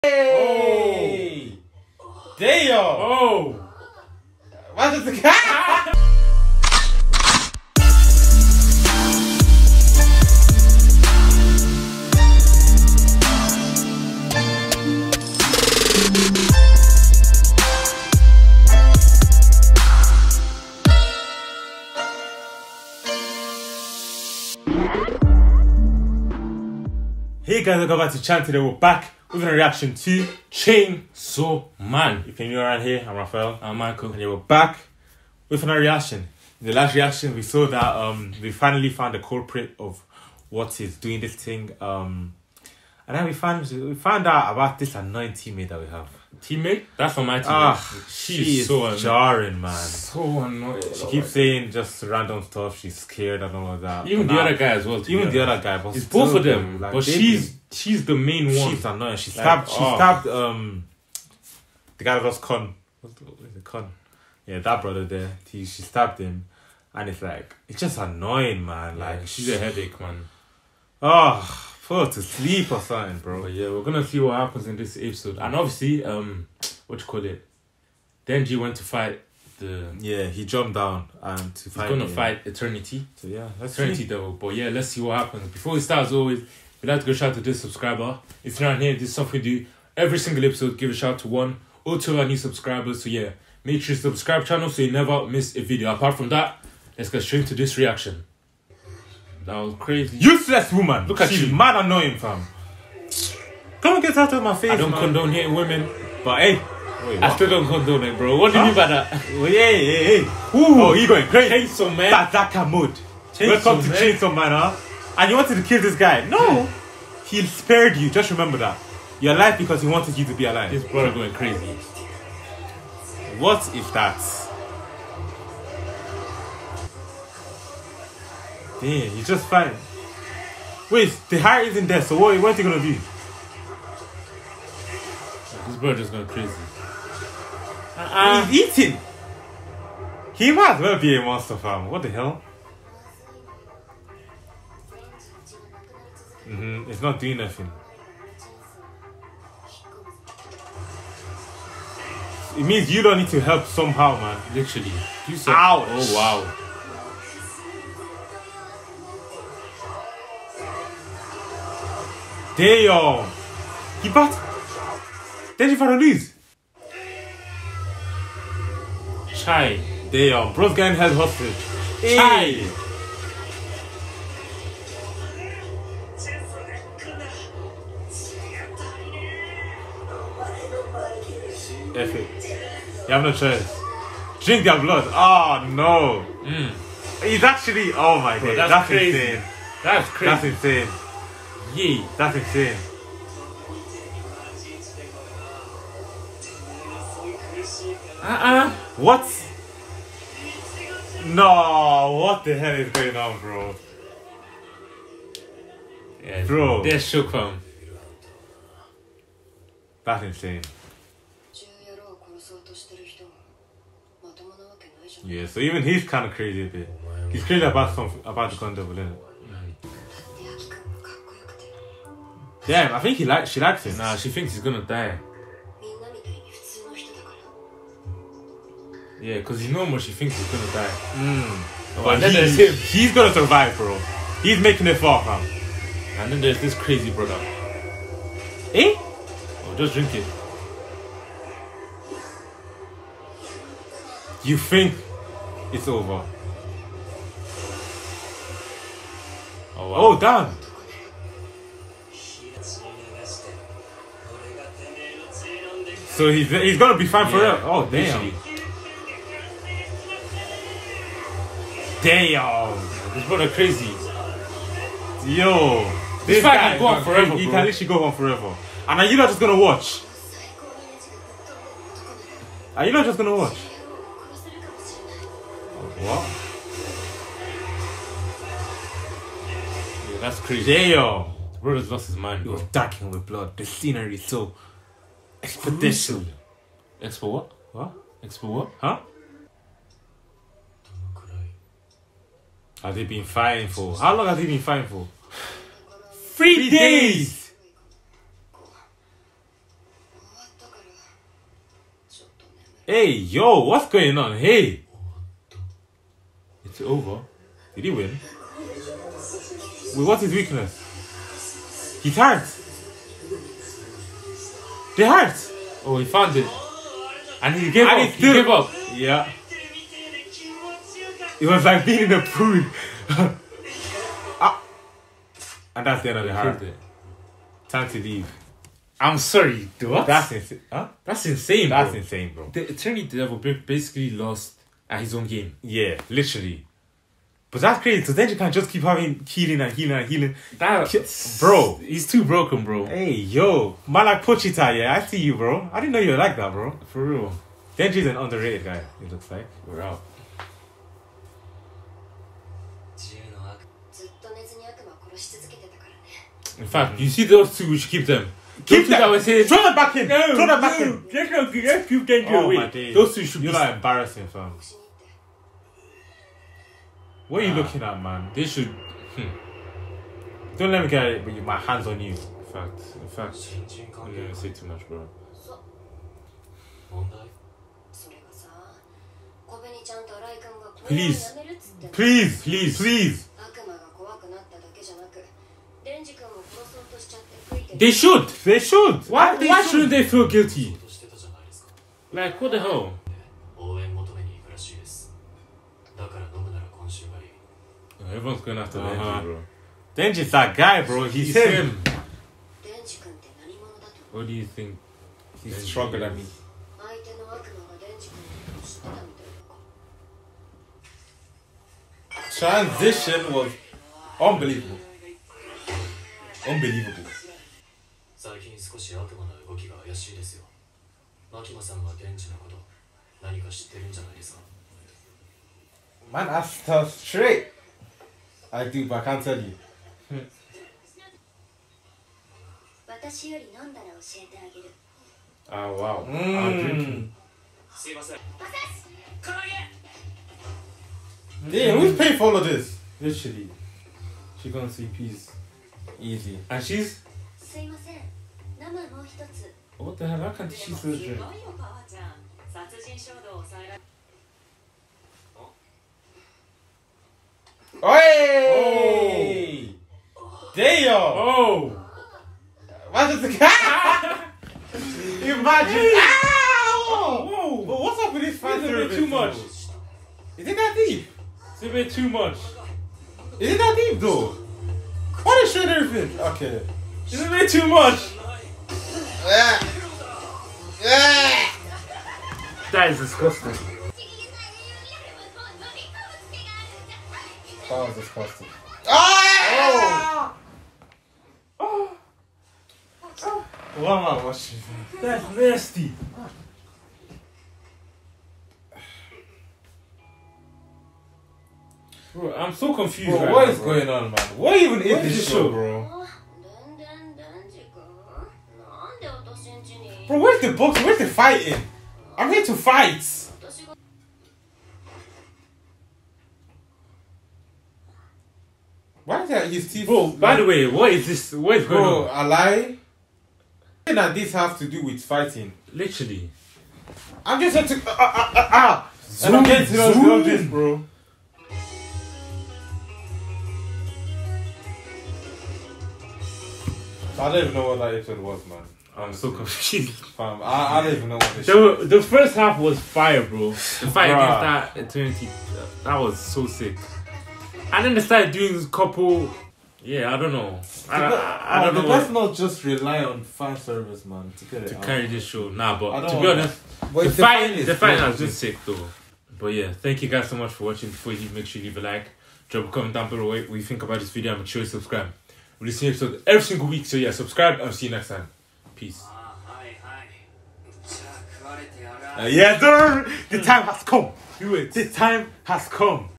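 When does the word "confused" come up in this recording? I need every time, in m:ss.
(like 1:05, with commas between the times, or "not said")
8:22, 8:59.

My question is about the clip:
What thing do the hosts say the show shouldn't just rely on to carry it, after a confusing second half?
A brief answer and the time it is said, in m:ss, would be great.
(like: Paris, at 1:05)
Fan service, at 9:13.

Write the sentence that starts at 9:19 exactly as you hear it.
But yeah, thank you guys so much for watching.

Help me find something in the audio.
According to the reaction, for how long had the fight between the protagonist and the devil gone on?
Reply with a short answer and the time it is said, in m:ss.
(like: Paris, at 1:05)
3 days, at 4:56.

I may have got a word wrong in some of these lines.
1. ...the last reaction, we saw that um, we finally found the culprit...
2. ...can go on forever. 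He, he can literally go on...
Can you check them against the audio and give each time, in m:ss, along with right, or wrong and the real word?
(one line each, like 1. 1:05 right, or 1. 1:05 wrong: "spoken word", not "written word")
1. 0:36 right
2. 4:26 right.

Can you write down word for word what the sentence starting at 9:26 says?
So yeah, subscribe and see you next time.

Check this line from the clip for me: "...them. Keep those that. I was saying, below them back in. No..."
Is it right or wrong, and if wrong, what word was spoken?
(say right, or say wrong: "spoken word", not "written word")
wrong: "throw", not "below".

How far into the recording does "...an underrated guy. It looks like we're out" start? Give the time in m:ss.
5:48.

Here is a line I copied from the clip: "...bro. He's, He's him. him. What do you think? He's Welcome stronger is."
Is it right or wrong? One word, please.
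wrong.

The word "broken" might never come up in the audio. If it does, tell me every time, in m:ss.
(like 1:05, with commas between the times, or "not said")
5:42.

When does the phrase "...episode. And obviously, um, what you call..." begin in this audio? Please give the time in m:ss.
1:14.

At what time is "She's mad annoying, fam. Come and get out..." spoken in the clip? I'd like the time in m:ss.
1:41.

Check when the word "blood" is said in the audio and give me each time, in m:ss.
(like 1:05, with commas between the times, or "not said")
3:04, 4:43.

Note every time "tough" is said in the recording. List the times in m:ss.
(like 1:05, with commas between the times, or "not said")
7:06.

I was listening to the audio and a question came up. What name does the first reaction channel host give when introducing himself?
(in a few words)
Raphael.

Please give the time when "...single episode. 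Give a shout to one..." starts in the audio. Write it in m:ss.
1:30.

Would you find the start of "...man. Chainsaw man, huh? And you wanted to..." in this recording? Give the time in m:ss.
1:53.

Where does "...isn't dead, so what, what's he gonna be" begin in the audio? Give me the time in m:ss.
2:11.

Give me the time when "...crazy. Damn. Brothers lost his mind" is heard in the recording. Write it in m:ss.
4:40.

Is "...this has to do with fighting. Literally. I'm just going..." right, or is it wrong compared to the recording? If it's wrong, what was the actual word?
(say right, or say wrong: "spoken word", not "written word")
right.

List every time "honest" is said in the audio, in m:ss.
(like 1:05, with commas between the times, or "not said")
9:16.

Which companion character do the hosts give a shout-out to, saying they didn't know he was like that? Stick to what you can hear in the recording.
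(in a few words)
Pochita.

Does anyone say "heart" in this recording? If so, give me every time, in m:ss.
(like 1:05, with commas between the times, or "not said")
2:11, 5:26.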